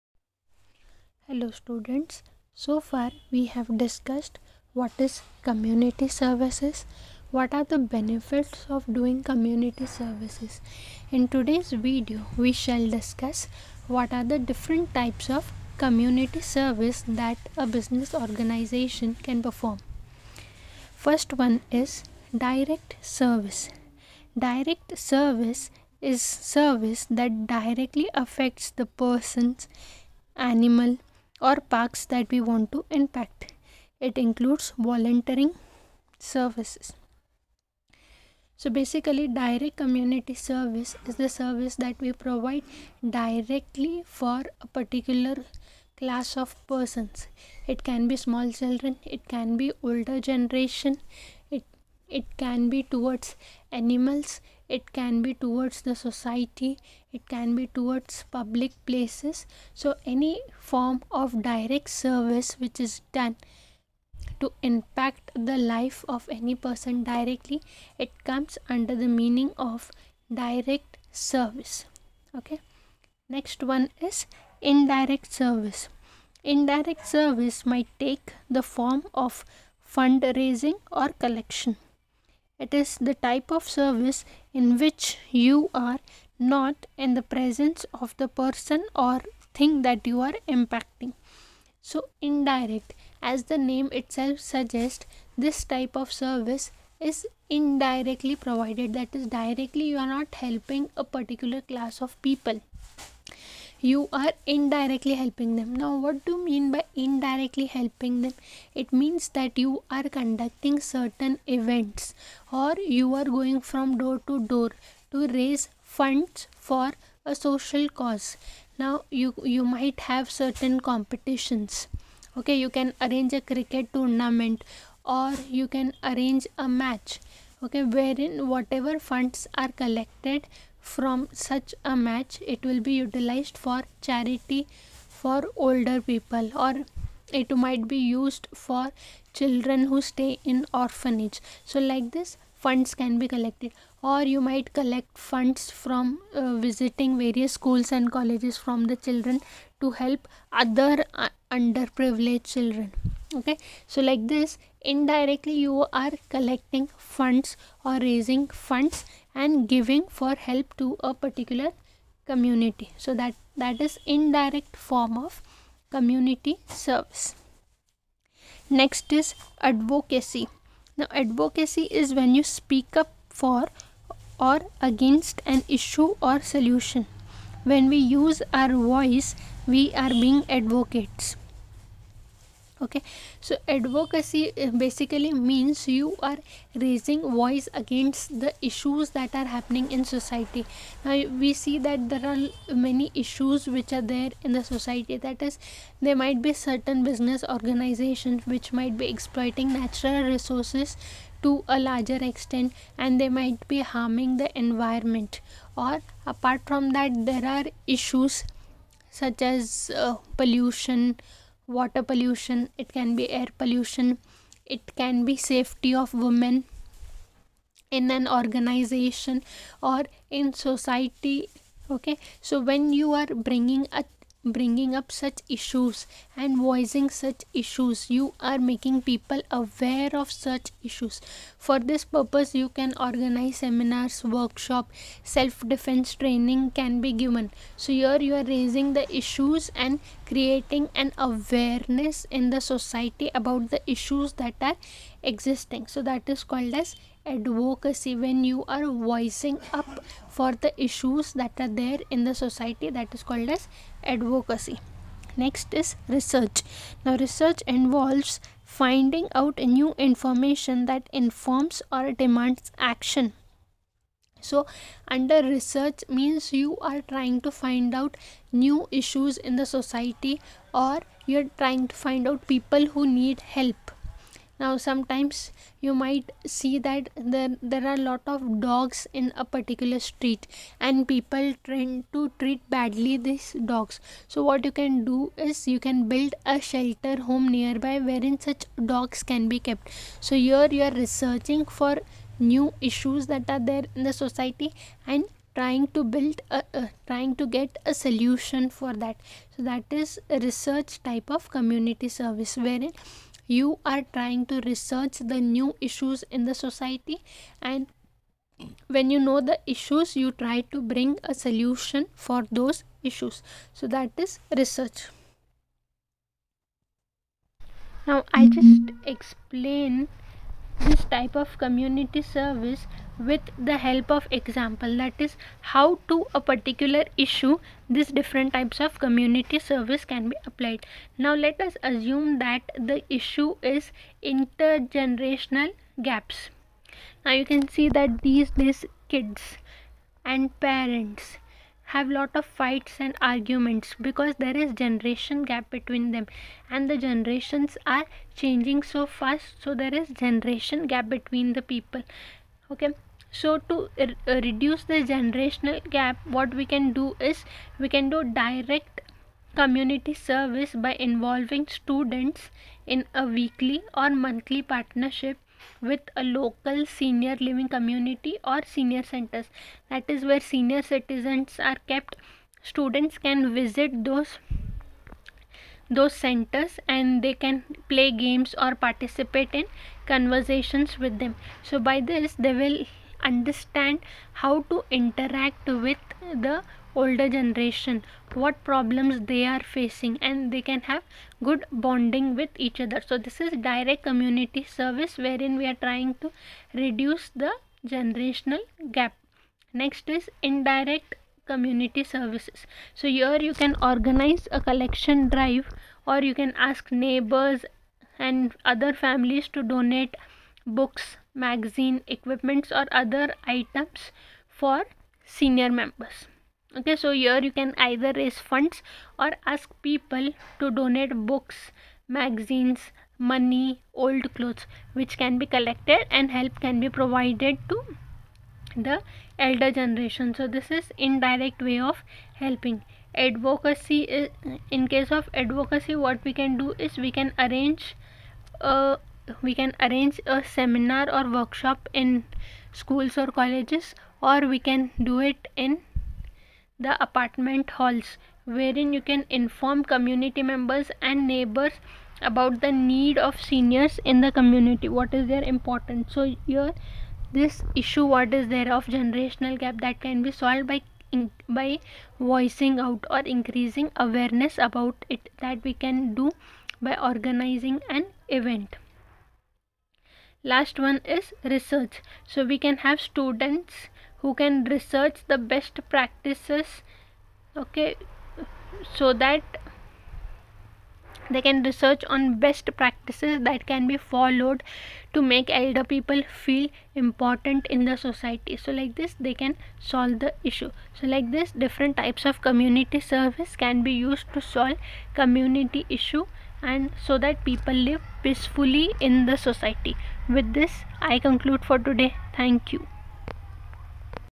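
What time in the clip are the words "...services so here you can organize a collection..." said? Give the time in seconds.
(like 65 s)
402 s.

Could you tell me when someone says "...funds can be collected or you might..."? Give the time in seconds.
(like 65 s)
142 s.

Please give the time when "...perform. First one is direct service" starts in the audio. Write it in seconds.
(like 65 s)
19 s.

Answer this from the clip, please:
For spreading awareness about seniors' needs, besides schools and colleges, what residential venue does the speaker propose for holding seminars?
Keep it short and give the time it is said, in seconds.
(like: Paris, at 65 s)
apartment halls, at 447 s.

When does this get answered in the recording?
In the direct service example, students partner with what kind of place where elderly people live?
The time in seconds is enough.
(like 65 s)
366 s.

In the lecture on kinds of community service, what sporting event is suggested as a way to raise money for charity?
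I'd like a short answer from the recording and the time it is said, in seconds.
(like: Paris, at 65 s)
cricket tournament, at 123 s.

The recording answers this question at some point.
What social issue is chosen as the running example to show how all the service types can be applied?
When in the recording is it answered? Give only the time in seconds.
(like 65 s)
334 s.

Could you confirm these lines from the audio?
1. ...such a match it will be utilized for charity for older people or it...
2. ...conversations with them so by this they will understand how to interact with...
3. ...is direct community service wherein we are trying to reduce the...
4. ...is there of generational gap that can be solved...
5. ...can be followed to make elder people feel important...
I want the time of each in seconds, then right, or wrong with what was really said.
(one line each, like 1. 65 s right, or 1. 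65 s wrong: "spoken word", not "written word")
1. 131 s right
2. 380 s right
3. 393 s right
4. 458 s right
5. 483 s right.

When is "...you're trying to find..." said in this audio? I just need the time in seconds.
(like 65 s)
271 s.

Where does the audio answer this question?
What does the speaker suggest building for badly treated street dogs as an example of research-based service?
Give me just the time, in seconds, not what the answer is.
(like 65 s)
286 s.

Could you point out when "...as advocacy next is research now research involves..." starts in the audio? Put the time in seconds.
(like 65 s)
253 s.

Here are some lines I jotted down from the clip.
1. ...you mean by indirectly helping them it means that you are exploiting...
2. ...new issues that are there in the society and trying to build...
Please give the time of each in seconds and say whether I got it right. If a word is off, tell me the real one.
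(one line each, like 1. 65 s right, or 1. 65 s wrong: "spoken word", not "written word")
1. 106 s wrong: "conducting", not "exploiting"
2. 292 s right.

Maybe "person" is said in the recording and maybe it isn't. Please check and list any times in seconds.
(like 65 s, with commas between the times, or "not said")
28 s, 46 s, 66 s, 88 s.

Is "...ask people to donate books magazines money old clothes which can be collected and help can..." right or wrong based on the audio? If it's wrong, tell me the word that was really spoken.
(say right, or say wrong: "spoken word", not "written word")
right.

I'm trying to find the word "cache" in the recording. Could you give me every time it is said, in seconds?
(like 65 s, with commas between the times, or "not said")
not said.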